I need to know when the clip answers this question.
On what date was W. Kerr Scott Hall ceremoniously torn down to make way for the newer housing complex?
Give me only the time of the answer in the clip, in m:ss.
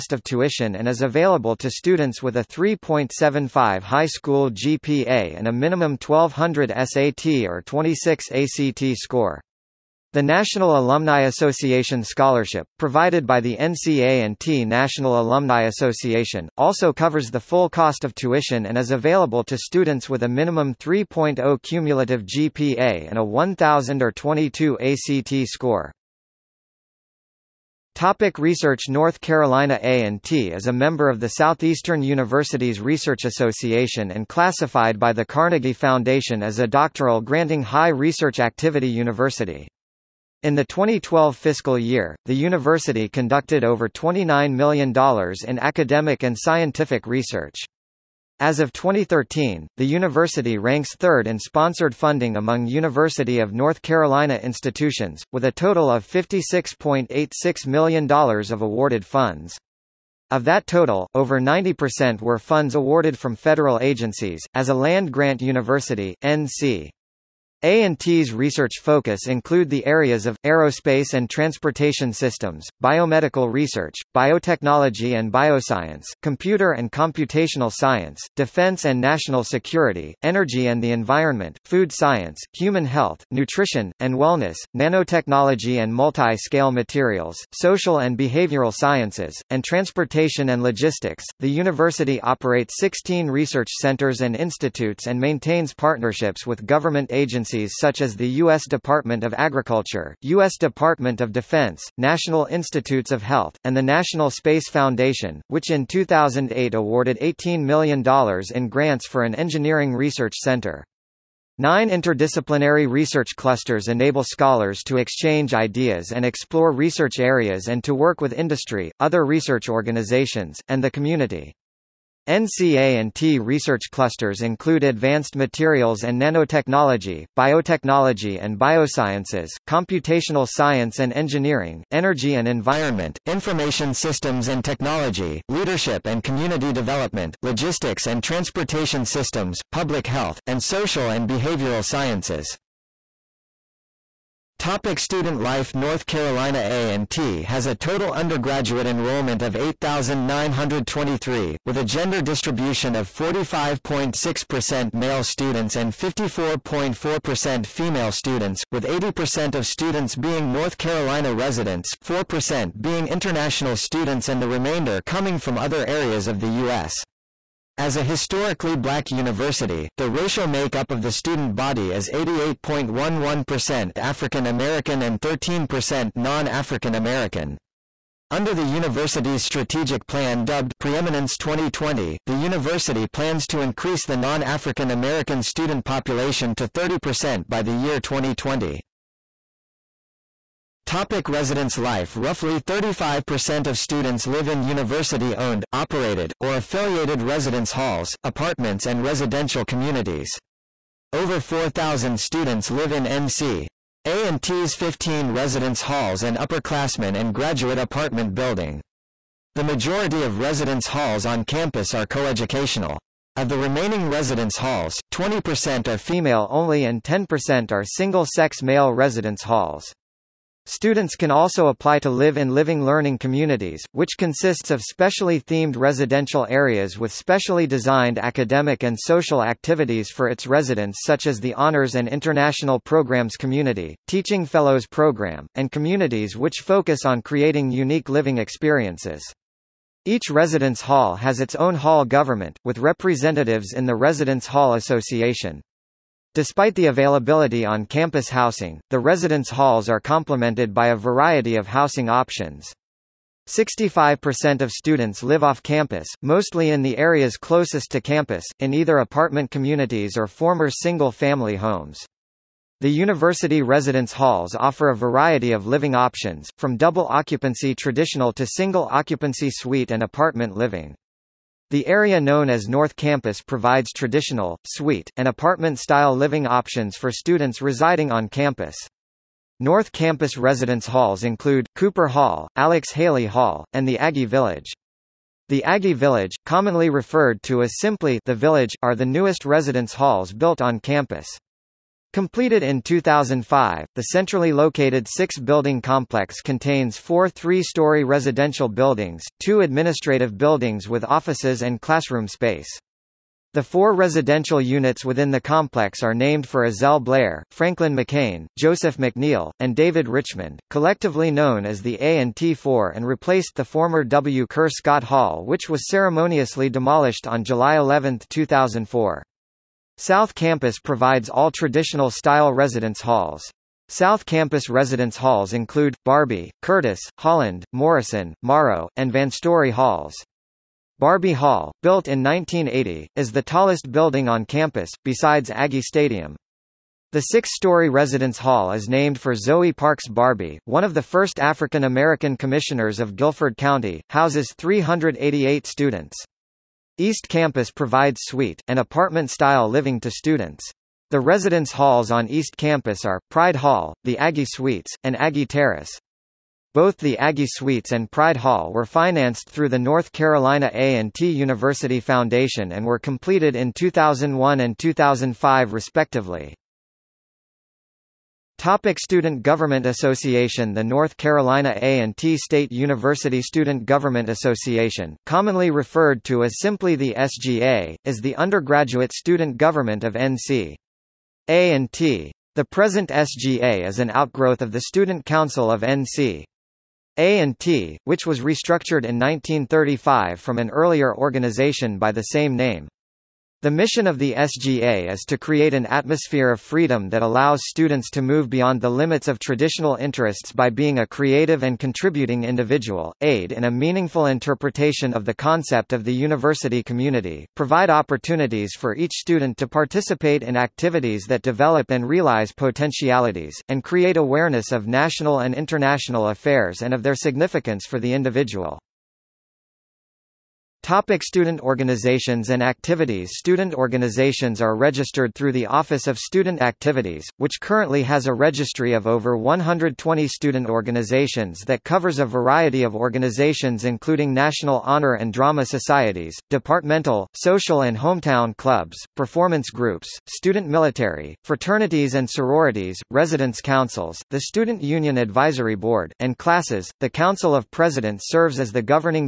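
5:17.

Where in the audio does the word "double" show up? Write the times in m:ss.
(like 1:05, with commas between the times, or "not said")
4:26.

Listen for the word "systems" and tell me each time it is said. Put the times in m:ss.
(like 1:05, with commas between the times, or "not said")
1:12, 2:13, 2:19.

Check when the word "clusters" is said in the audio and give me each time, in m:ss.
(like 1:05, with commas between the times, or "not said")
1:53, 2:03.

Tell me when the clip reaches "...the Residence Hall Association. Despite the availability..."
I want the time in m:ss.
4:03.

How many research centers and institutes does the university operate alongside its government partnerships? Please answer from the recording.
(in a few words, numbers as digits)
16.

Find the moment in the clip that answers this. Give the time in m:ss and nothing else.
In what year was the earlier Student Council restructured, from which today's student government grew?
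6:29.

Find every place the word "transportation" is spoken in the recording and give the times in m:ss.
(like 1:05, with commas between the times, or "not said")
1:11, 1:29, 2:18.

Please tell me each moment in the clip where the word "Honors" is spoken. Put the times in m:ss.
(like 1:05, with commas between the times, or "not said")
3:51, 7:14.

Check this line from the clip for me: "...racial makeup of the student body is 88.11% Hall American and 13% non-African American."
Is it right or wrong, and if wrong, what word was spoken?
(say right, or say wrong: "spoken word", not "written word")
wrong: "African", not "Hall".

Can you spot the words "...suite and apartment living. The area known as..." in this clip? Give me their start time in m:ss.
4:29.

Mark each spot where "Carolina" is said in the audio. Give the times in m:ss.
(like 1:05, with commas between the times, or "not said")
0:29, 0:53, 2:26, 2:40, 6:00, 6:11.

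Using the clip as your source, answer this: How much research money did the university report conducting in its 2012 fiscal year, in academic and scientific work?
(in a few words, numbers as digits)
over $29 million.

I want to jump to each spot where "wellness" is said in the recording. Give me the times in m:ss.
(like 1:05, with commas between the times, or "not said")
1:24.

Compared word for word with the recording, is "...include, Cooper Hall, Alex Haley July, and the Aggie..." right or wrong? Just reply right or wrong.
wrong.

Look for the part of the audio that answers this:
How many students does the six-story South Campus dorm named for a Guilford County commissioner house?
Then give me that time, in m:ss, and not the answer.
5:44.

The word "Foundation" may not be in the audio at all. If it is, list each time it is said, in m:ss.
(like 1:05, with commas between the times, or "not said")
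0:35, 1:44, 6:01.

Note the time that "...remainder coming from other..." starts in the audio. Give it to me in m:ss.
2:44.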